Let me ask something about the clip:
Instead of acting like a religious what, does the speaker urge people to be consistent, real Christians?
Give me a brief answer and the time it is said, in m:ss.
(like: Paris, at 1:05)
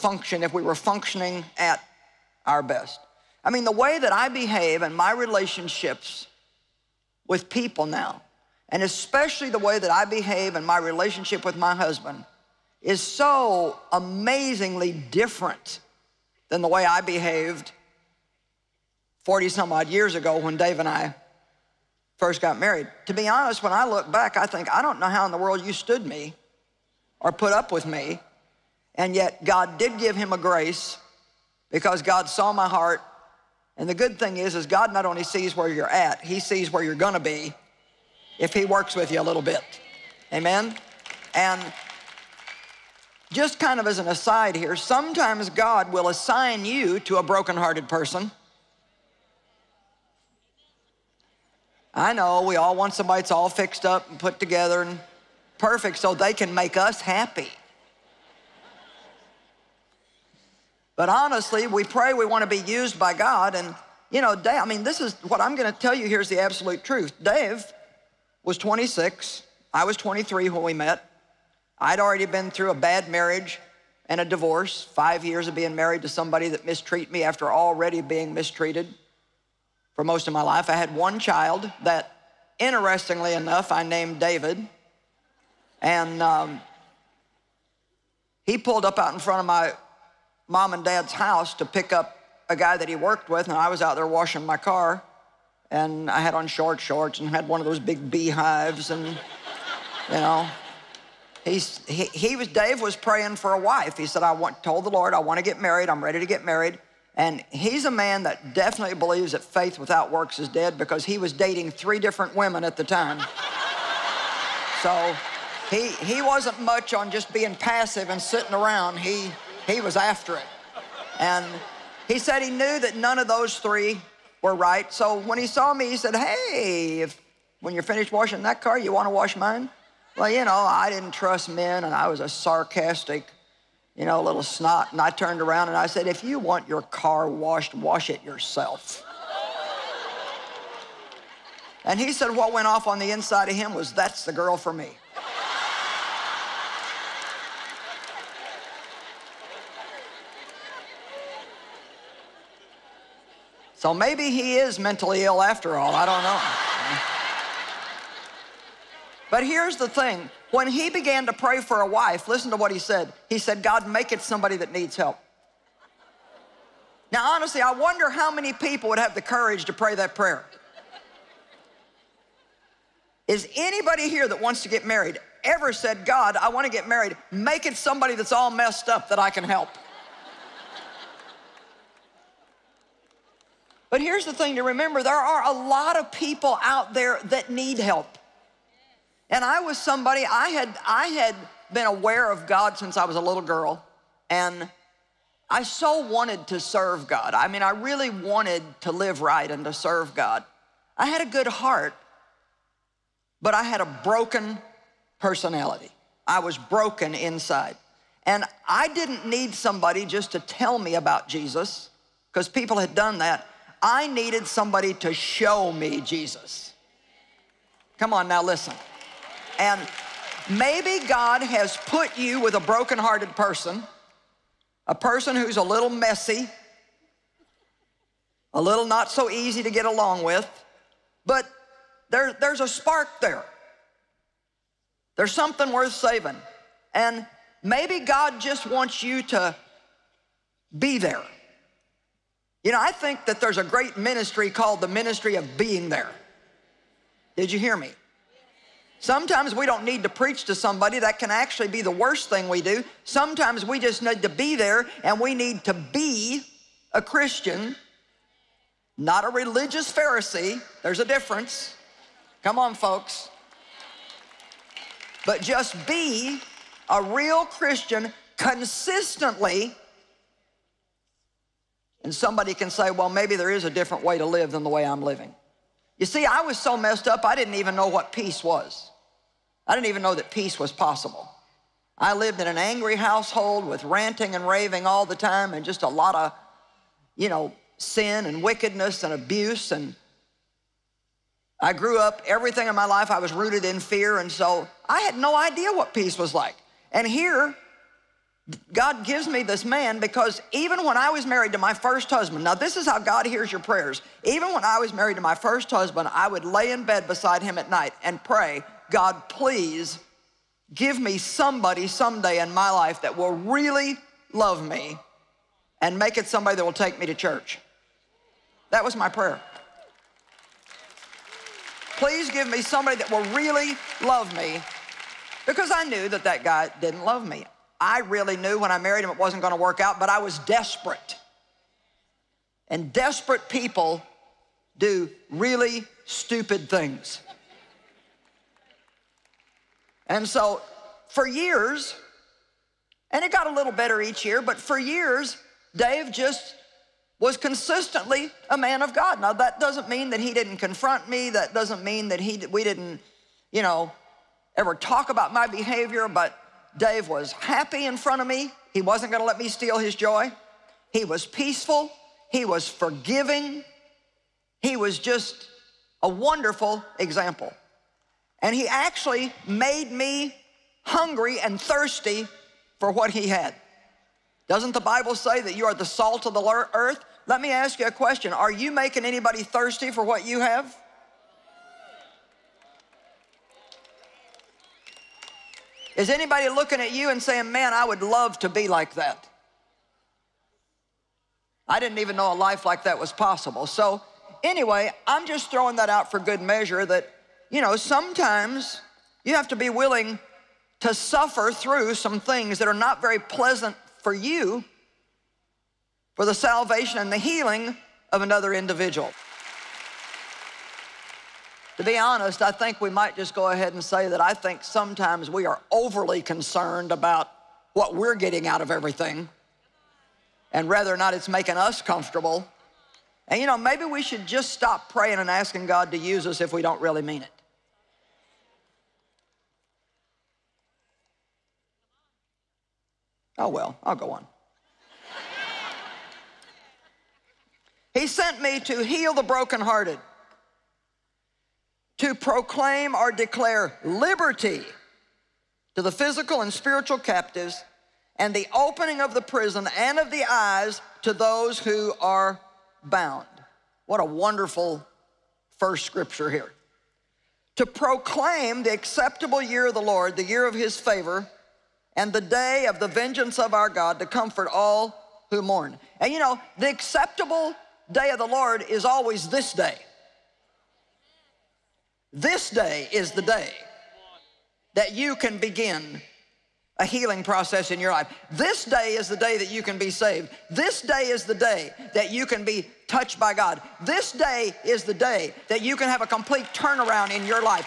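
Pharisee, at 4:19.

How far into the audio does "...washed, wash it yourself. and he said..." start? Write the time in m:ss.
2:17.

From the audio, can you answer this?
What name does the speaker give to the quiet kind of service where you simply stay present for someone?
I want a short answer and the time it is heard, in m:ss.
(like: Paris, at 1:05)
ministry of being there, at 4:04.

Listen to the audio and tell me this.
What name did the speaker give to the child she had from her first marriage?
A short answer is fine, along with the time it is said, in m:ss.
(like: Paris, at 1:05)
David, at 1:24.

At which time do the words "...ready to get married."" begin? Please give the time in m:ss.
1:46.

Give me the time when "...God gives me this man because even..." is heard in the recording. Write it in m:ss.
4:58.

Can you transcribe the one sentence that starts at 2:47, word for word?
Now, honestly, I wonder how many people would have the courage to pray that prayer.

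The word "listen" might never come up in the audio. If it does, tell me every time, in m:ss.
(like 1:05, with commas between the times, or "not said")
2:42, 3:38.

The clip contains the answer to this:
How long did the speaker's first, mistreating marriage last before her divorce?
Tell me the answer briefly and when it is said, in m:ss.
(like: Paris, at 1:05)
5 years, at 1:14.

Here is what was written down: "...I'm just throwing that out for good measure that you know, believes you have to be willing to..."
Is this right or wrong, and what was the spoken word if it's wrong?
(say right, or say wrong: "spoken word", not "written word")
wrong: "sometimes", not "believes".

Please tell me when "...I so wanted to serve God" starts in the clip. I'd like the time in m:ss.
3:15.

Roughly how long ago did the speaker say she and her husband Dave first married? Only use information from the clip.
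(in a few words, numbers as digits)
40 some odd years.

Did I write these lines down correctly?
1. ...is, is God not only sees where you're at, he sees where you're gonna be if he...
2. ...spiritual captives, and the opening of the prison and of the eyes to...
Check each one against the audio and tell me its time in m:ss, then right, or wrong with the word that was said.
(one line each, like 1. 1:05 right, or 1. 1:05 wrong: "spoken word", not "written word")
1. 0:34 right
2. 7:26 right.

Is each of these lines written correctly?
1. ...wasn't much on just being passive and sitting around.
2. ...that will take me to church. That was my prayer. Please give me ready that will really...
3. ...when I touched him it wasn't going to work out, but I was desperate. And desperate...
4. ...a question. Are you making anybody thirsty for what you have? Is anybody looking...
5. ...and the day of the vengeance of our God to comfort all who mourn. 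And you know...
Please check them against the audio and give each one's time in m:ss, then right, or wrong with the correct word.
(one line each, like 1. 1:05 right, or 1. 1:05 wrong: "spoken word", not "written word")
1. 1:56 right
2. 5:16 wrong: "somebody", not "ready"
3. 5:28 wrong: "married", not "touched"
4. 6:17 right
5. 7:41 right.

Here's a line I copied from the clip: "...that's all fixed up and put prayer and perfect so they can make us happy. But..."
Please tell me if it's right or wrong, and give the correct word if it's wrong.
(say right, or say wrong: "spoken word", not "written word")
wrong: "together", not "prayer".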